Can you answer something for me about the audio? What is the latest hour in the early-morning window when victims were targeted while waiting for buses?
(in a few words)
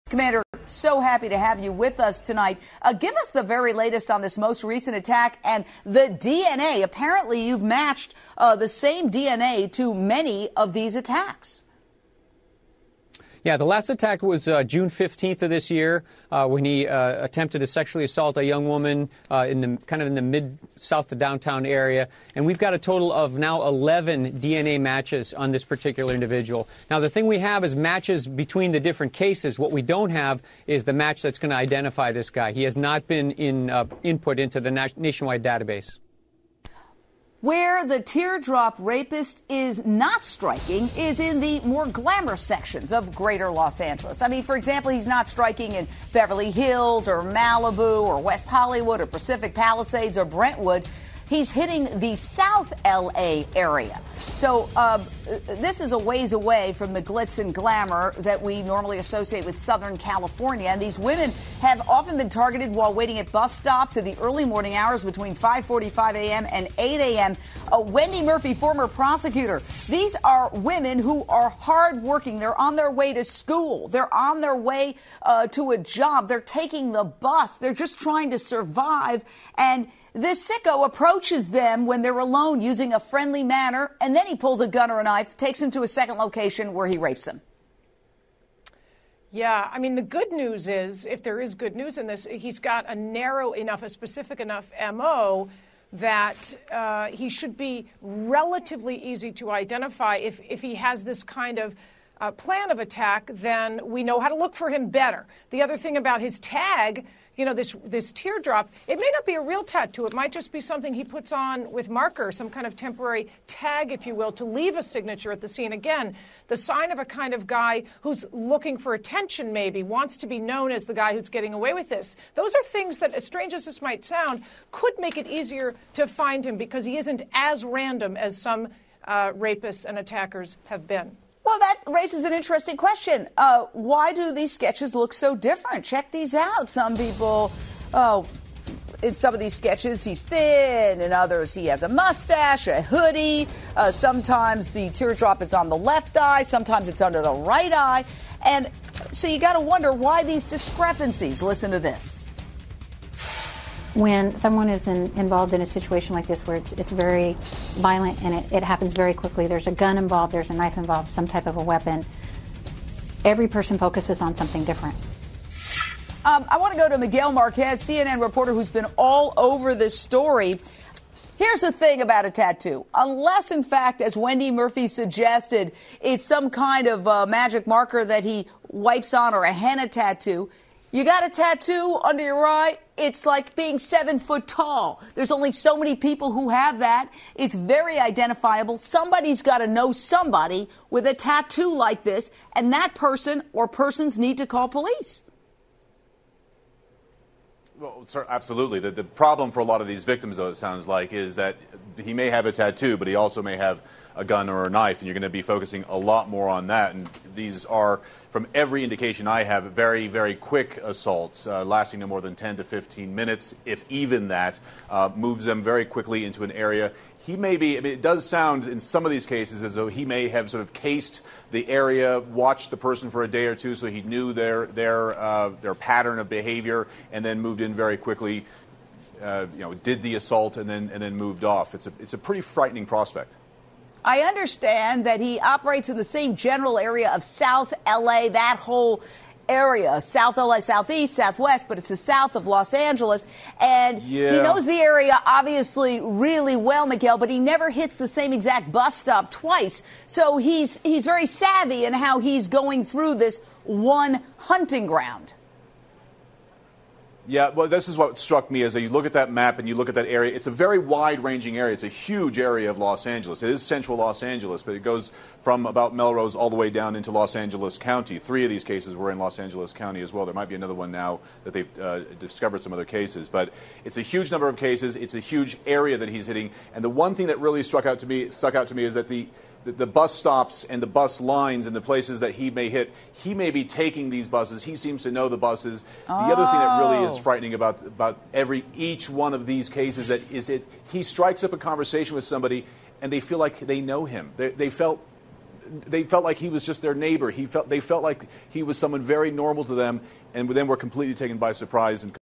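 8 a.m.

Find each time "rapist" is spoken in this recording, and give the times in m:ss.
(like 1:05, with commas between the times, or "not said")
0:38, 2:09.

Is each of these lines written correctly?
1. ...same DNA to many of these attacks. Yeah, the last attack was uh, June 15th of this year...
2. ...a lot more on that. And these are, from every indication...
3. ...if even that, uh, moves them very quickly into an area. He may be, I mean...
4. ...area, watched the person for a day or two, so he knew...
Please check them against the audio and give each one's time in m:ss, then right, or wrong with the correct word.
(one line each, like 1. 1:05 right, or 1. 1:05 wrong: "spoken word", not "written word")
1. 0:08 right
2. 3:25 right
3. 3:33 right
4. 3:41 right.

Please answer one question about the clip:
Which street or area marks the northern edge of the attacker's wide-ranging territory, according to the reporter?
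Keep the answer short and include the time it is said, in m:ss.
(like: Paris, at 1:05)
Melrose, at 4:25.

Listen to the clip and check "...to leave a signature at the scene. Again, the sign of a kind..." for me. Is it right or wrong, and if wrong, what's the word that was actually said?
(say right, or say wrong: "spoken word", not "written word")
right.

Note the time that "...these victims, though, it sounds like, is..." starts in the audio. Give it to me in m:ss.
3:19.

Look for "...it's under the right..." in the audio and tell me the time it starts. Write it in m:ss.
2:26.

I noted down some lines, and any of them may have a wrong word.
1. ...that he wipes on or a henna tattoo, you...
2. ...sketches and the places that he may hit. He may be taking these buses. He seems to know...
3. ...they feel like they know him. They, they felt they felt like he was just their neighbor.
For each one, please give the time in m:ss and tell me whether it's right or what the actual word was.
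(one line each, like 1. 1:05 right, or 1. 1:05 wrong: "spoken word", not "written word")
1. 2:58 right
2. 4:41 wrong: "lines", not "sketches"
3. 4:53 right.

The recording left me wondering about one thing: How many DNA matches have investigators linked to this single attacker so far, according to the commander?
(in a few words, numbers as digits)
11.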